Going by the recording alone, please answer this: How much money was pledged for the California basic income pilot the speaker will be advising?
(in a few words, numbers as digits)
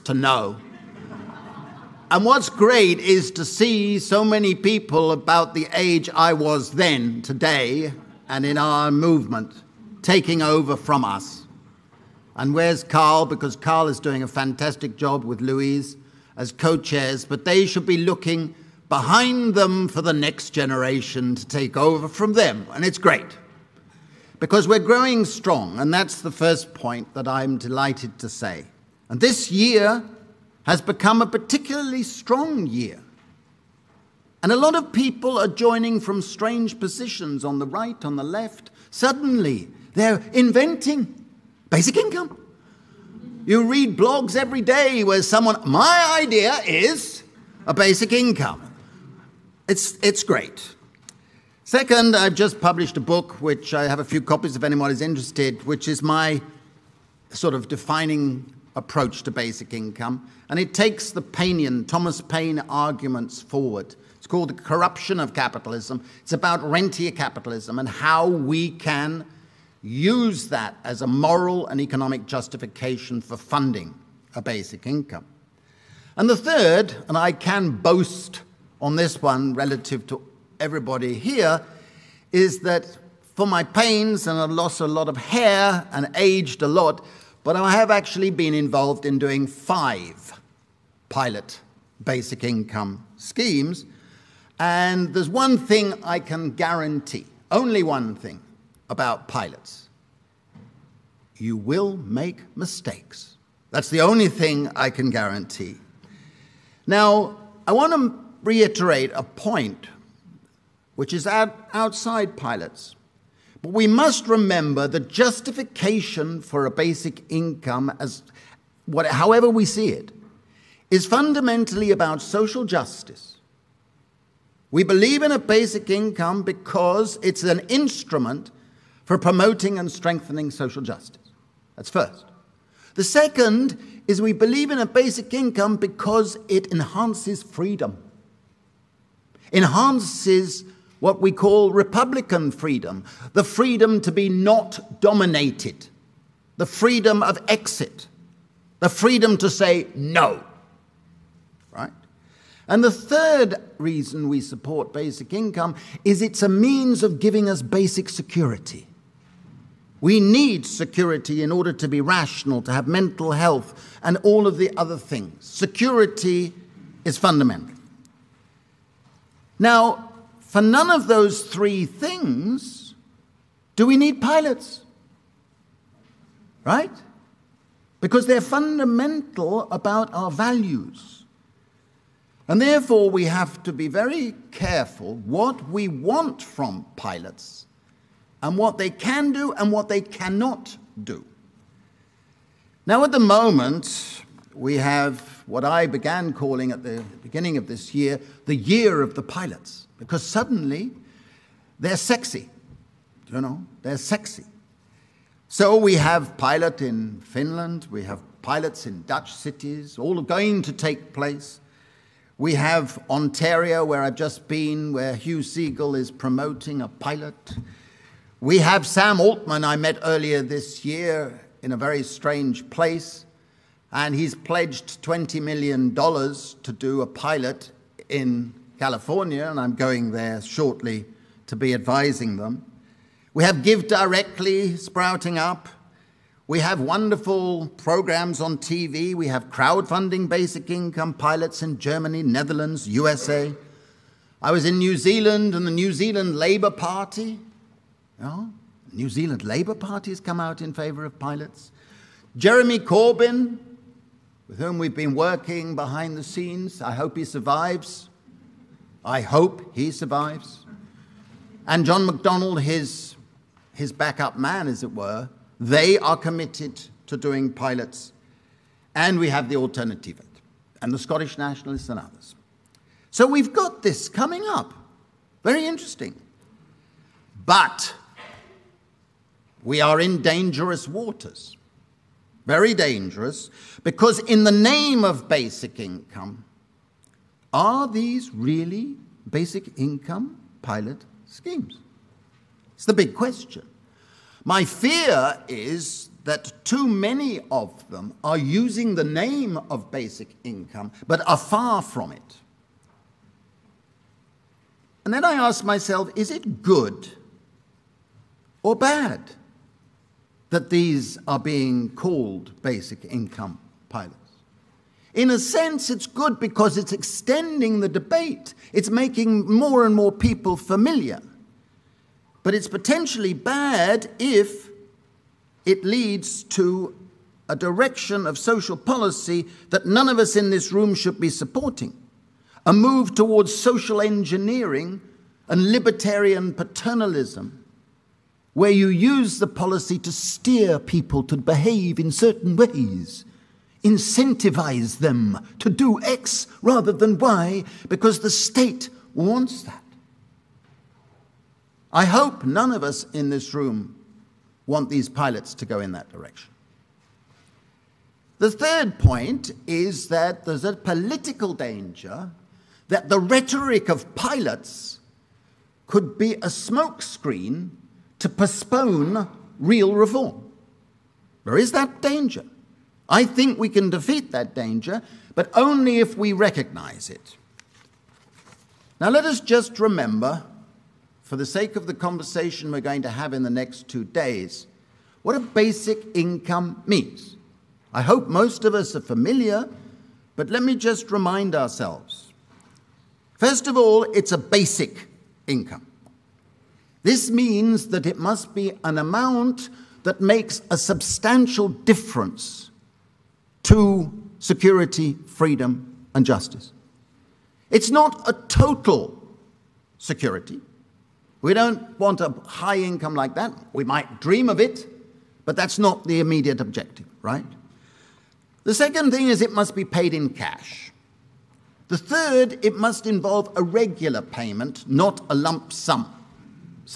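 $20 million.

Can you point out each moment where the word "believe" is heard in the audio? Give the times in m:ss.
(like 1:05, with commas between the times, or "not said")
2:04, 2:14.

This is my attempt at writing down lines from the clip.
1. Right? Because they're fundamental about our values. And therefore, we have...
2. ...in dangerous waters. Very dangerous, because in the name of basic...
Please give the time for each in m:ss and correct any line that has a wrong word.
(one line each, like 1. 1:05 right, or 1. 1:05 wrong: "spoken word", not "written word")
1. 2:56 right
2. 4:39 right.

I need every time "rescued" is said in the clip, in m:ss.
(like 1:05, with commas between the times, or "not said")
not said.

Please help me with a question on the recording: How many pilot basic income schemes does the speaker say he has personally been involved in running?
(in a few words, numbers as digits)
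5.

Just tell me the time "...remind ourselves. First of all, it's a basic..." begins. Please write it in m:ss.
6:31.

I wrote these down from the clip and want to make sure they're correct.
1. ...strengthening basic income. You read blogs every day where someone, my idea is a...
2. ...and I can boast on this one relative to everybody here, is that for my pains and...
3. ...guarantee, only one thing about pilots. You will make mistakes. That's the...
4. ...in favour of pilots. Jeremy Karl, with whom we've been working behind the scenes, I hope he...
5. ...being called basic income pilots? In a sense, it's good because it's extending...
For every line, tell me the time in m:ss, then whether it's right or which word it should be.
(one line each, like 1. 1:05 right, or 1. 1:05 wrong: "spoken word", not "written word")
1. 0:40 wrong: "inventing", not "strengthening"
2. 1:17 right
3. 1:36 right
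4. 4:10 wrong: "Corbyn", not "Karl"
5. 5:11 right.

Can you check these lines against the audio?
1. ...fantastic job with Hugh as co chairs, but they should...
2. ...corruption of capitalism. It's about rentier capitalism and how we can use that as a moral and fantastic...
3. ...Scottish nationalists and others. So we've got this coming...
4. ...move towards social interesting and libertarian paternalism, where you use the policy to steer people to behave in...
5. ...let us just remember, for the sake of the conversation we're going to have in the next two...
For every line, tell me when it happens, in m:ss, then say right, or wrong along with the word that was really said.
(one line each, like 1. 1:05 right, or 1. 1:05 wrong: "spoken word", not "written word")
1. 0:14 wrong: "Louise", not "Hugh"
2. 1:04 wrong: "economic", not "fantastic"
3. 4:30 right
4. 5:32 wrong: "engineering", not "interesting"
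5. 6:19 right.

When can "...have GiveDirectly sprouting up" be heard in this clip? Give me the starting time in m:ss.
3:53.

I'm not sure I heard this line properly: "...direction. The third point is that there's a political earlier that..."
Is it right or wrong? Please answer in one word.
wrong.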